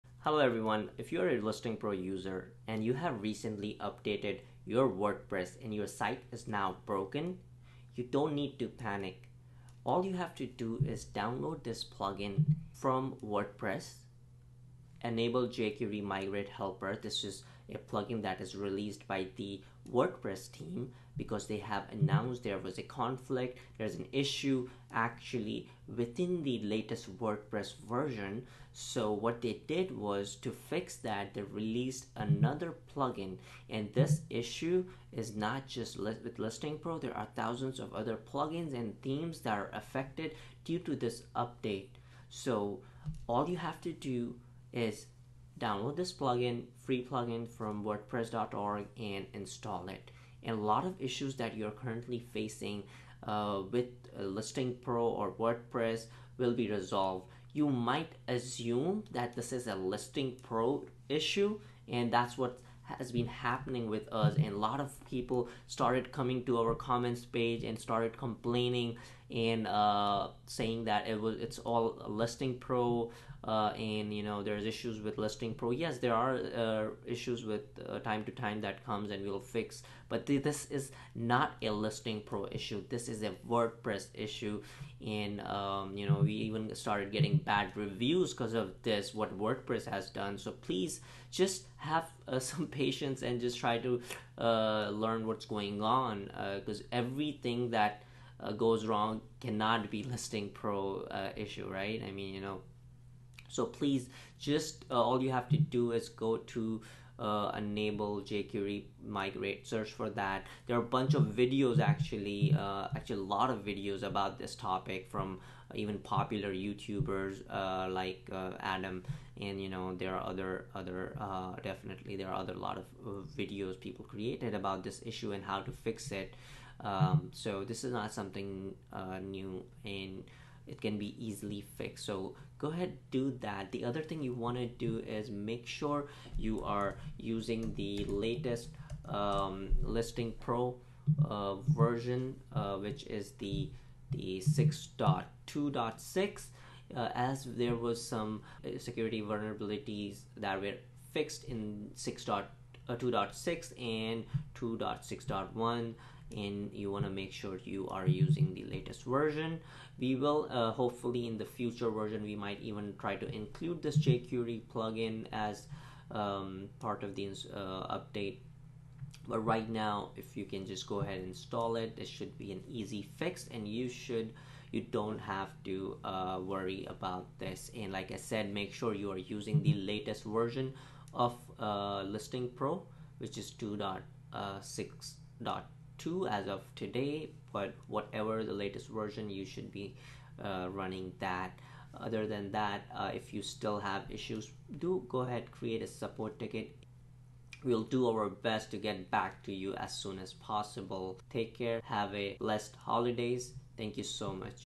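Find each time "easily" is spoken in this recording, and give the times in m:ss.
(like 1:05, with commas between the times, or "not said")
2:11.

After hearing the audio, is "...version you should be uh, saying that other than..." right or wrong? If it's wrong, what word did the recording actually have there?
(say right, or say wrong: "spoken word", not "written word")
wrong: "running", not "saying".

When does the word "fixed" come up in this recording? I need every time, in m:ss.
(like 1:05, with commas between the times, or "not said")
2:11, 2:31.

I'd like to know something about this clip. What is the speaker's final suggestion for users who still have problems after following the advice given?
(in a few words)
Create a support ticket.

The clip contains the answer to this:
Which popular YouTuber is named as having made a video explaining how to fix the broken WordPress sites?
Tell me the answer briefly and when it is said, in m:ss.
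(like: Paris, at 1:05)
Adam, at 1:58.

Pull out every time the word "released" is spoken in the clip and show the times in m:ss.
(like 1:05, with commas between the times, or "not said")
0:18, 0:31.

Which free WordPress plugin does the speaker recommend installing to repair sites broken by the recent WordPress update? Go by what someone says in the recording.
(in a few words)
Enable jQuery Migrate Helper.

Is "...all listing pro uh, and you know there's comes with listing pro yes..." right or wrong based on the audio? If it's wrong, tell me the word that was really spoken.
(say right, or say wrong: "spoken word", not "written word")
wrong: "issues", not "comes".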